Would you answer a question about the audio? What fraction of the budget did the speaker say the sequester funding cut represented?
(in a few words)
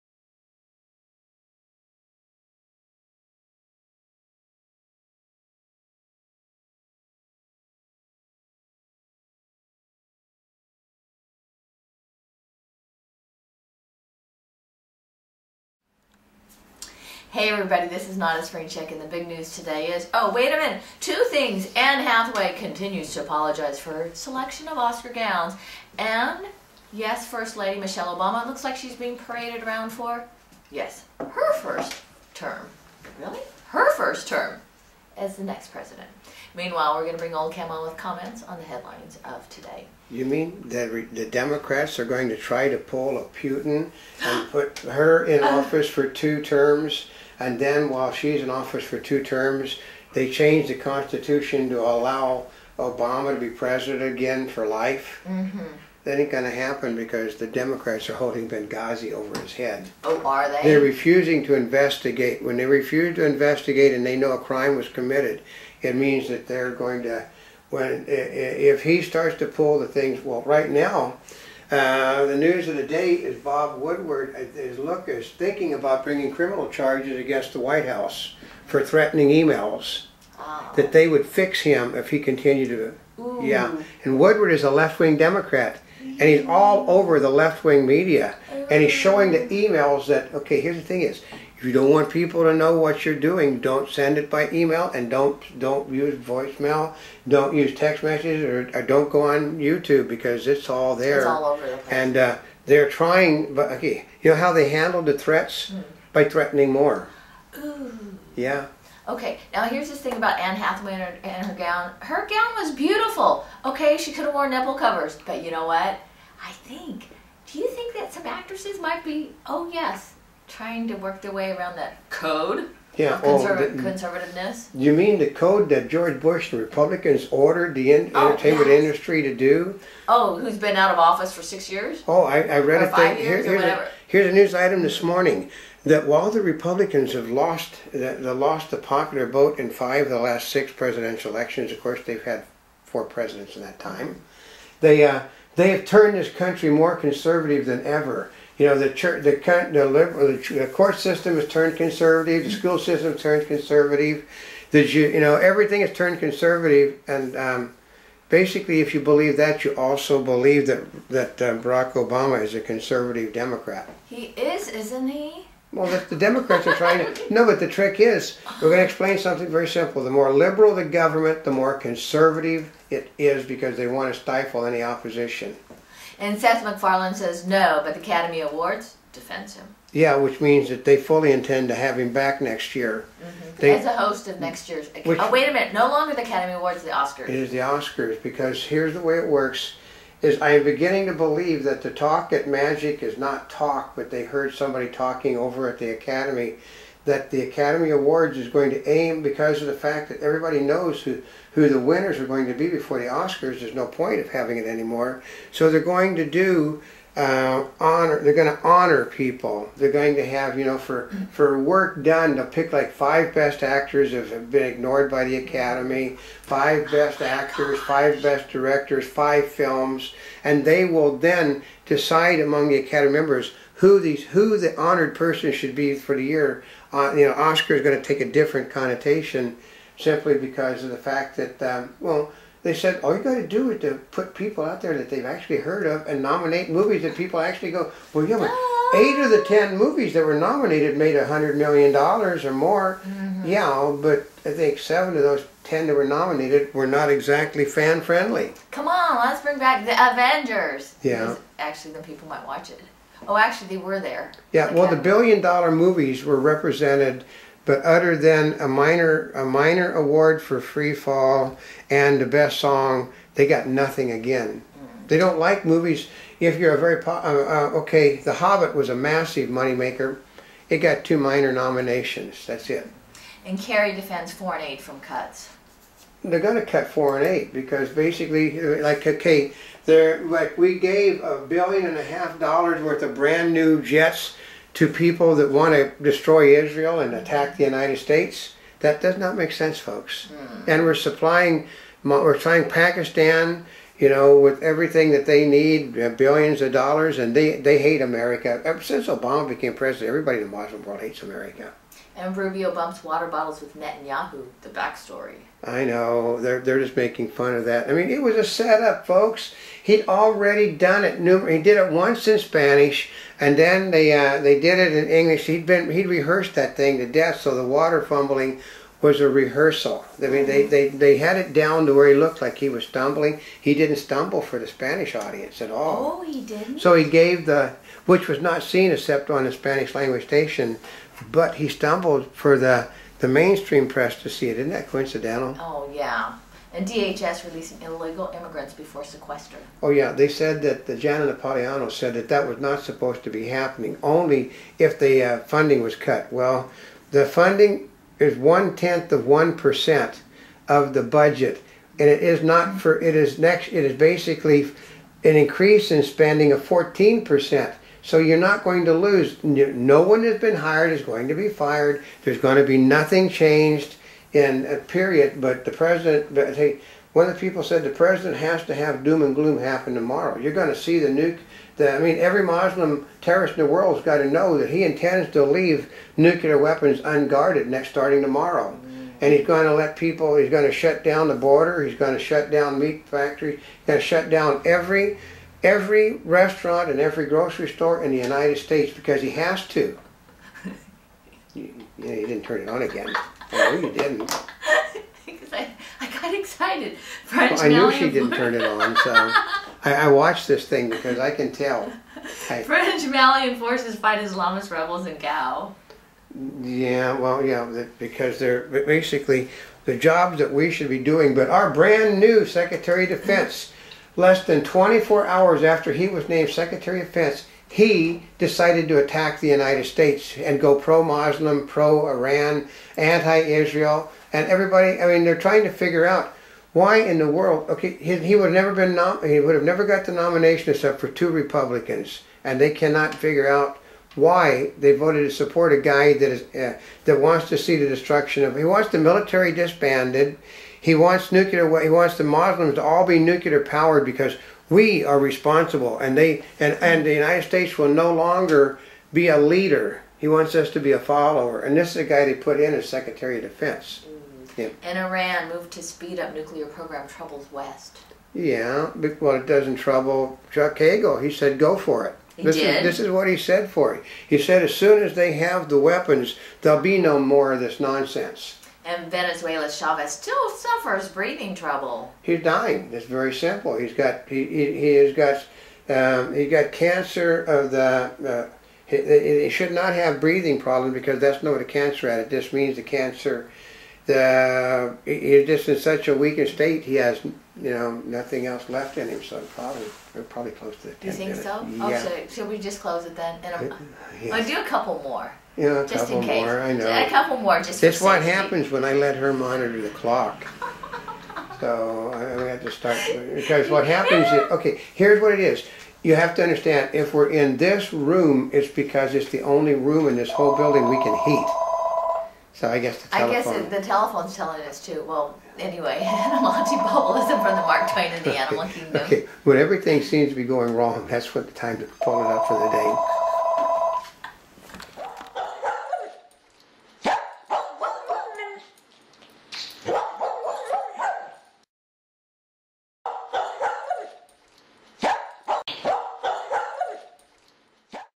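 one tenth of 1%.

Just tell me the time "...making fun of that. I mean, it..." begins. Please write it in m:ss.
5:06.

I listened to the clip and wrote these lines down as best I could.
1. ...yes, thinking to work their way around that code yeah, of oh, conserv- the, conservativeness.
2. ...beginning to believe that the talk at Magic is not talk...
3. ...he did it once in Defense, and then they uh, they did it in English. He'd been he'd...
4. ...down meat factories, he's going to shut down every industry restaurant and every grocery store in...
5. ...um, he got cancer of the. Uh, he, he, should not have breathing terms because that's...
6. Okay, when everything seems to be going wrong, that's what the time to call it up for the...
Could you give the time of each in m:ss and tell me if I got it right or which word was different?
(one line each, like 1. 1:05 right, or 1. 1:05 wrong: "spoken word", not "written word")
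1. 1:59 wrong: "trying", not "thinking"
2. 3:10 right
3. 5:11 wrong: "Spanish", not "Defense"
4. 6:22 wrong: "every", not "industry"
5. 7:55 wrong: "problems", not "terms"
6. 8:39 right.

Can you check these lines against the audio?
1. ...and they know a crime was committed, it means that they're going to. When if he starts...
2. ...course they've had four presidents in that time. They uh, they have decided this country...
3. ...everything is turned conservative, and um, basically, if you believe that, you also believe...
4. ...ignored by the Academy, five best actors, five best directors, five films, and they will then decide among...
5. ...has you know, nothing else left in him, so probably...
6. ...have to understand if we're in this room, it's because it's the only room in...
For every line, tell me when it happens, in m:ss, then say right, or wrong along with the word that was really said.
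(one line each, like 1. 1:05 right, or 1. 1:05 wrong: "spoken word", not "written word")
1. 1:03 right
2. 2:21 wrong: "turned", not "decided"
3. 2:35 right
4. 3:34 right
5. 8:06 right
6. 8:26 right.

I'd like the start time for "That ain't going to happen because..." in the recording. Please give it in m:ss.
0:56.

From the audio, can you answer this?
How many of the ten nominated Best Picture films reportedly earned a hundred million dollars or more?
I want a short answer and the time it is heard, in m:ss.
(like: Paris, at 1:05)
8, at 3:58.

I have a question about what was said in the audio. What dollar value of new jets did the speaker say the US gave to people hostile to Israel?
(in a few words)
a billion and a half dollars.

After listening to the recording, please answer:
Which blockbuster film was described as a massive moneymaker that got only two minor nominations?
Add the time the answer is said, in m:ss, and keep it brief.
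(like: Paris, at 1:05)
The Hobbit, at 4:28.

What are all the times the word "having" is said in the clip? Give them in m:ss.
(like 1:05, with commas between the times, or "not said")
3:24.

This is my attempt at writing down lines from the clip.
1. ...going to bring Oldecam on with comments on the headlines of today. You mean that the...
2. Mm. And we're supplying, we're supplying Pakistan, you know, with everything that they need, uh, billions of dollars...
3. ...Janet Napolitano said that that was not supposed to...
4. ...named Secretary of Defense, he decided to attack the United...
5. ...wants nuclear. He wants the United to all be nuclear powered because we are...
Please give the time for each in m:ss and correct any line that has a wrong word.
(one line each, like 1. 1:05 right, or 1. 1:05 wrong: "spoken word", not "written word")
1. 0:37 right
2. 4:50 right
3. 5:40 right
4. 6:56 right
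5. 7:20 wrong: "Muslims", not "United".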